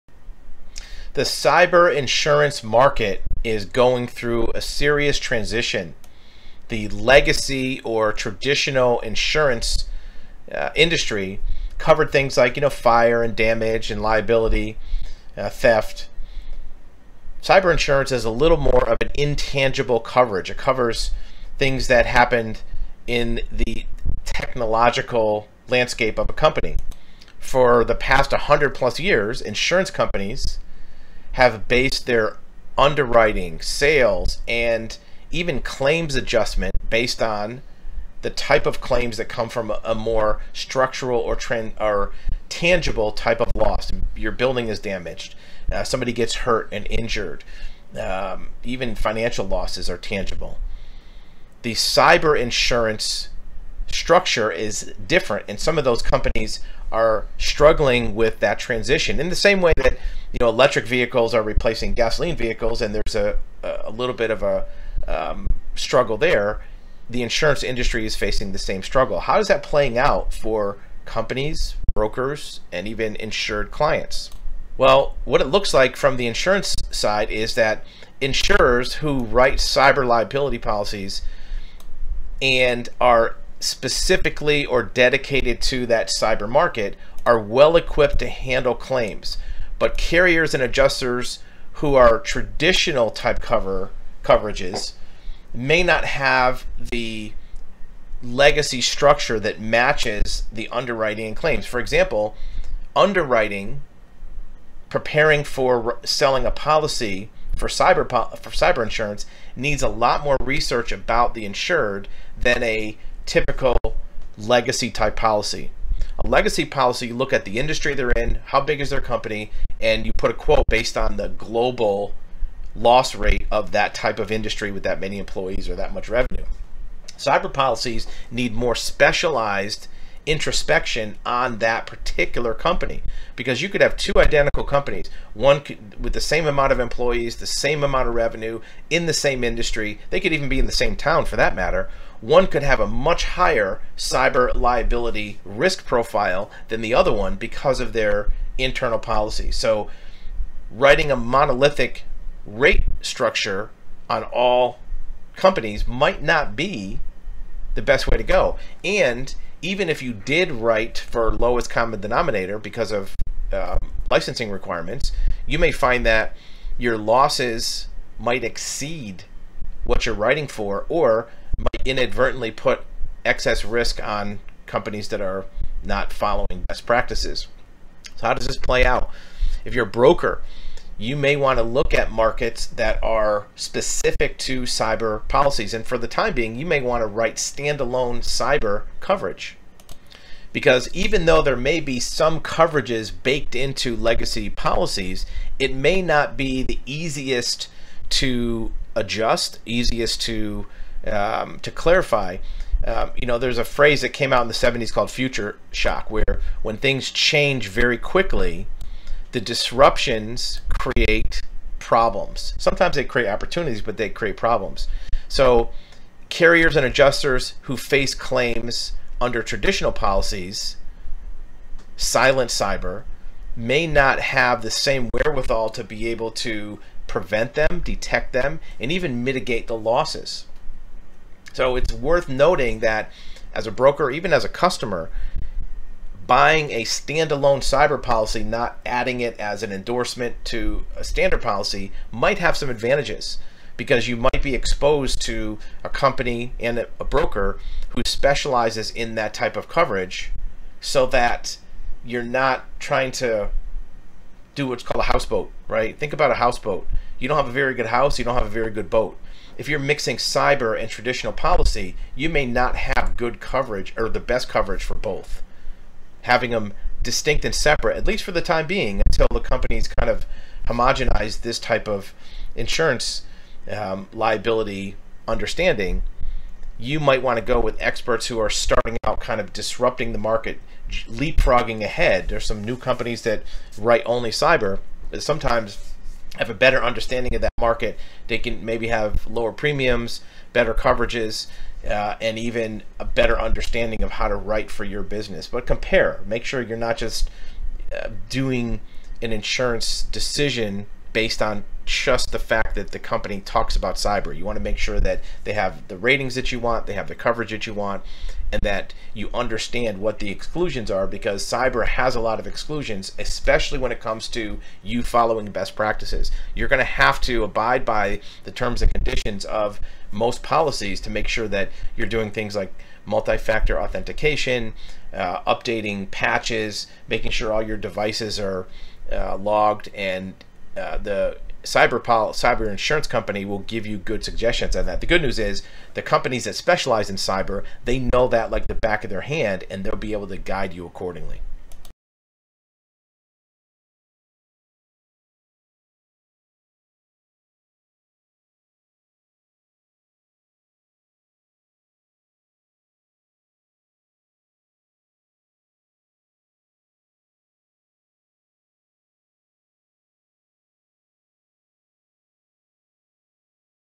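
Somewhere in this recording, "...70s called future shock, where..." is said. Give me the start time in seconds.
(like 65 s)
204 s.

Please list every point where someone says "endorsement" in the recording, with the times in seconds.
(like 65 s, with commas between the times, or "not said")
239 s.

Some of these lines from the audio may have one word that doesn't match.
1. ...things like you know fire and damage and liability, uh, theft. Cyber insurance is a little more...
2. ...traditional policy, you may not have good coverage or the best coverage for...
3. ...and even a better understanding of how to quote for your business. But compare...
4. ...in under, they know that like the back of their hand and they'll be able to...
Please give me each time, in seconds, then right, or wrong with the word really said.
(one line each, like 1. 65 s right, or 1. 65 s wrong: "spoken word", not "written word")
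1. 12 s right
2. 260 s right
3. 292 s wrong: "write", not "quote"
4. 337 s wrong: "cyber", not "under".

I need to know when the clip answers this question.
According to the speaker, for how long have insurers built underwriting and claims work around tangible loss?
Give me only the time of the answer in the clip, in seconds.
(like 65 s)
28 s.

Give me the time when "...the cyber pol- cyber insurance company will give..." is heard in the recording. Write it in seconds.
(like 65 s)
330 s.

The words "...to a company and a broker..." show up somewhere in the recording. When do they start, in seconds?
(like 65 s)
245 s.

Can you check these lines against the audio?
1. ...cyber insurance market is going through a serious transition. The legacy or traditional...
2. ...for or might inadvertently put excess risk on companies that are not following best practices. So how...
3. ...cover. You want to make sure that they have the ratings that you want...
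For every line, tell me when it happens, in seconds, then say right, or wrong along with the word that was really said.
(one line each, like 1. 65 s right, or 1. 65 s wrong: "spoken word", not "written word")
1. 1 s right
2. 170 s right
3. 303 s wrong: "cyber", not "cover".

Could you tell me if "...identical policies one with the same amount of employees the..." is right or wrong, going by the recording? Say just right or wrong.
wrong.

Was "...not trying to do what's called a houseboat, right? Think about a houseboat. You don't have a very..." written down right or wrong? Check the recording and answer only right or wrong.
right.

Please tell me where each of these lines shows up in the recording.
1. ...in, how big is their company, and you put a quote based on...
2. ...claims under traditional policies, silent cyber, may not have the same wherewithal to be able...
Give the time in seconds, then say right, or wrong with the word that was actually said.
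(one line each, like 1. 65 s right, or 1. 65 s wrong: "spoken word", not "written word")
1. 118 s right
2. 218 s right.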